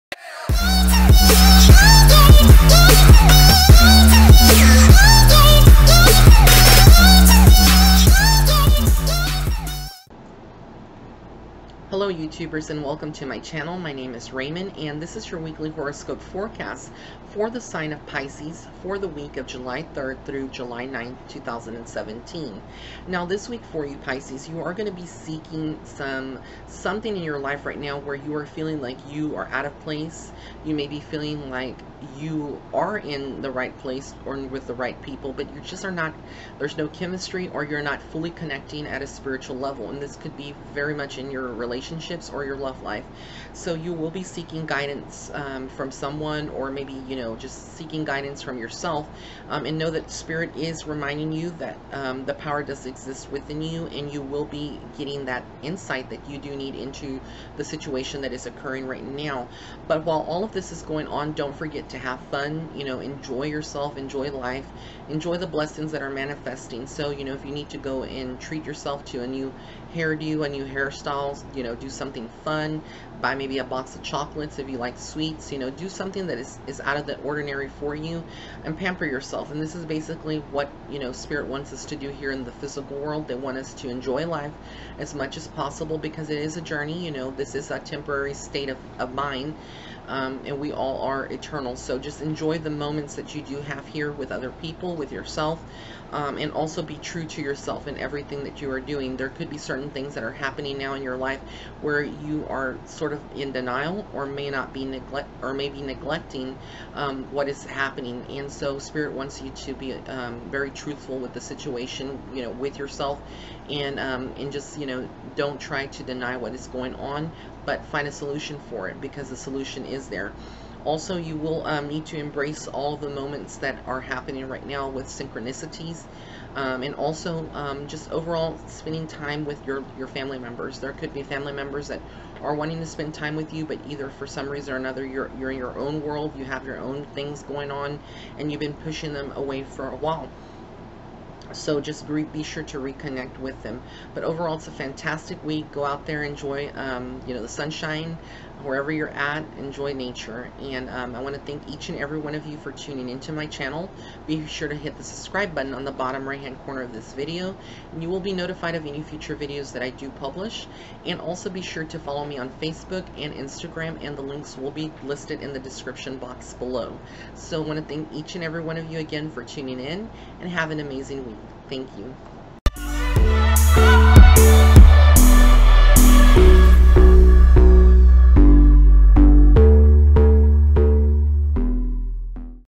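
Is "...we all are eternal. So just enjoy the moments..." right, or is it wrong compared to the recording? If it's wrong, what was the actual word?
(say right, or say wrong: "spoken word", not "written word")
right.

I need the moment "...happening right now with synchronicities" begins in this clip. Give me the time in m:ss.
2:04.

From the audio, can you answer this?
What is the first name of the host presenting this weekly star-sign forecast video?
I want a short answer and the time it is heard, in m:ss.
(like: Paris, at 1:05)
Raymond, at 0:14.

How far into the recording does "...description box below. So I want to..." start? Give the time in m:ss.
2:45.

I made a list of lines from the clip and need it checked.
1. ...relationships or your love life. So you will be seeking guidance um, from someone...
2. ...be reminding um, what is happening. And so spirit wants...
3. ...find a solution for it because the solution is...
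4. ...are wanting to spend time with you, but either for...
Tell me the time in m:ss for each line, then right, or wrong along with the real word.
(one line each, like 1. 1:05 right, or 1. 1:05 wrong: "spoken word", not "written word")
1. 0:41 right
2. 1:45 wrong: "neglecting", not "reminding"
3. 1:57 right
4. 2:12 right.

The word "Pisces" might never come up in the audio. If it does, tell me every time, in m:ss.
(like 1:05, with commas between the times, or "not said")
0:18, 0:23.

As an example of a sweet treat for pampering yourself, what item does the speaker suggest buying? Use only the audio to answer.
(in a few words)
box of chocolates.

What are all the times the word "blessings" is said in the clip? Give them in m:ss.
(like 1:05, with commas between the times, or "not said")
1:05.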